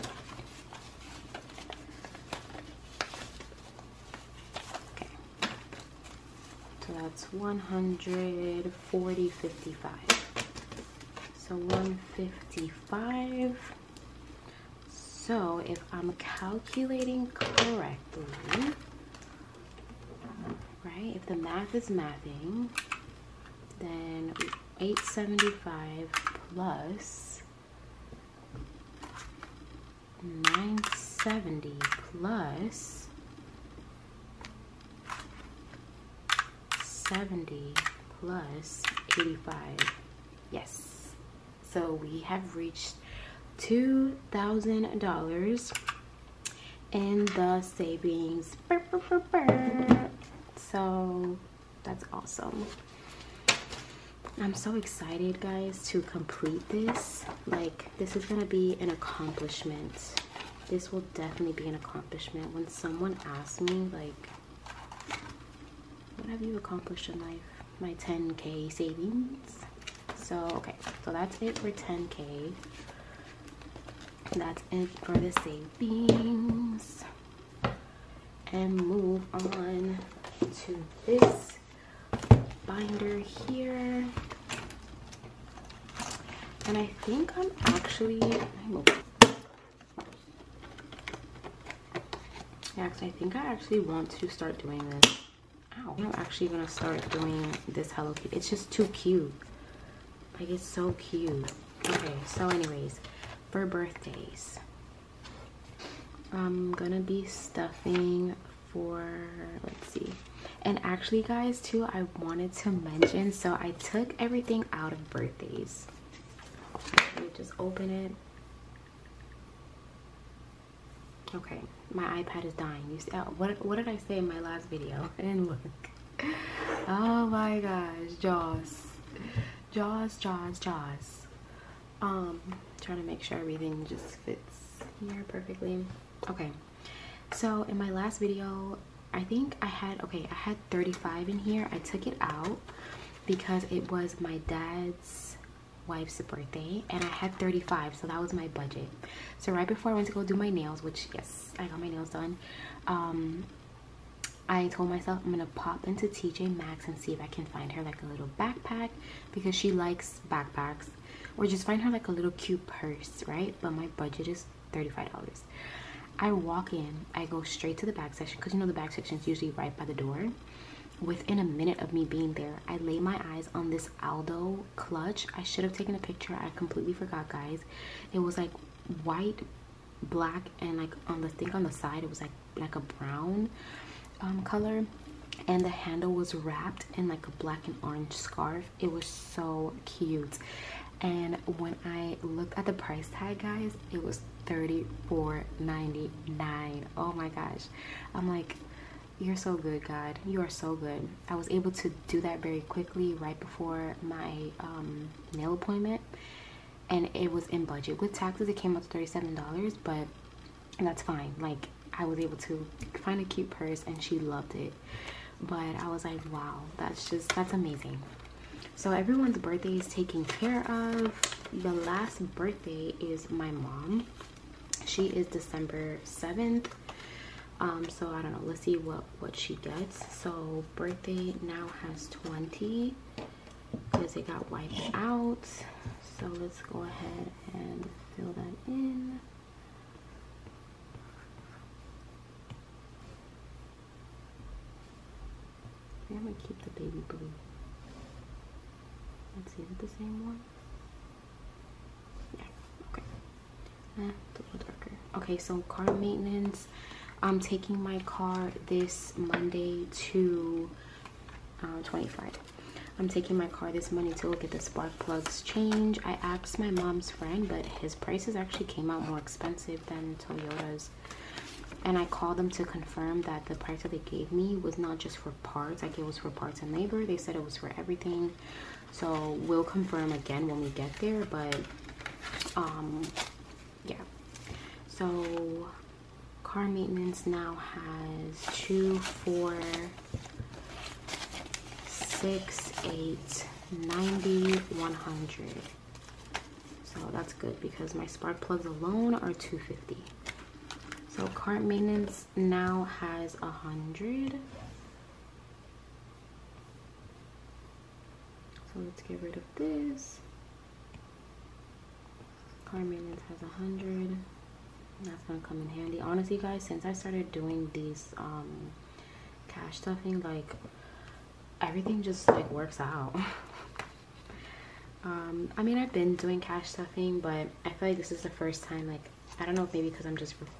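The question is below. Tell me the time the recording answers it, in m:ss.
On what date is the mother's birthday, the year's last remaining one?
3:45.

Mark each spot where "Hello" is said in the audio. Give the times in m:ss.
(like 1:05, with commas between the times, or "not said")
1:37.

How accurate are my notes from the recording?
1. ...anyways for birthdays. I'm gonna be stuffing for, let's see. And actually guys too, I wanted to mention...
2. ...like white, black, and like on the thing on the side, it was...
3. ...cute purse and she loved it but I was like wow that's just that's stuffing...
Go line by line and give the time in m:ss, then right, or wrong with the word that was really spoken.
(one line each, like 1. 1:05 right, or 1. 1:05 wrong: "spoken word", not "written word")
1. 1:42 right
2. 2:58 right
3. 3:33 wrong: "amazing", not "stuffing".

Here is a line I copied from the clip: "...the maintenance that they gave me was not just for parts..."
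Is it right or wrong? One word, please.
wrong.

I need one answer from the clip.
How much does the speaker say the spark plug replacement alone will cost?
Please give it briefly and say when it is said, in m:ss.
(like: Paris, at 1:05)
250, at 4:59.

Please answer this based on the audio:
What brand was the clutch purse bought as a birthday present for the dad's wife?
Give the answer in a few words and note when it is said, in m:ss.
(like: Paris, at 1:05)
Aldo, at 2:54.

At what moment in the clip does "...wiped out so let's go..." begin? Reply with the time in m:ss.
3:54.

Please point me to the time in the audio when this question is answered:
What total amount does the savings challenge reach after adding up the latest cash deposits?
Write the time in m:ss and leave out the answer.
0:43.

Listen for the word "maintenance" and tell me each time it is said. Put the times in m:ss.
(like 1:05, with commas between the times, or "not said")
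4:15, 4:46, 5:01, 5:12.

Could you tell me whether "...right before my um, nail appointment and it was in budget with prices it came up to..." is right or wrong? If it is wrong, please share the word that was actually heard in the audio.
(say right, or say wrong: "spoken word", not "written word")
wrong: "taxes", not "prices".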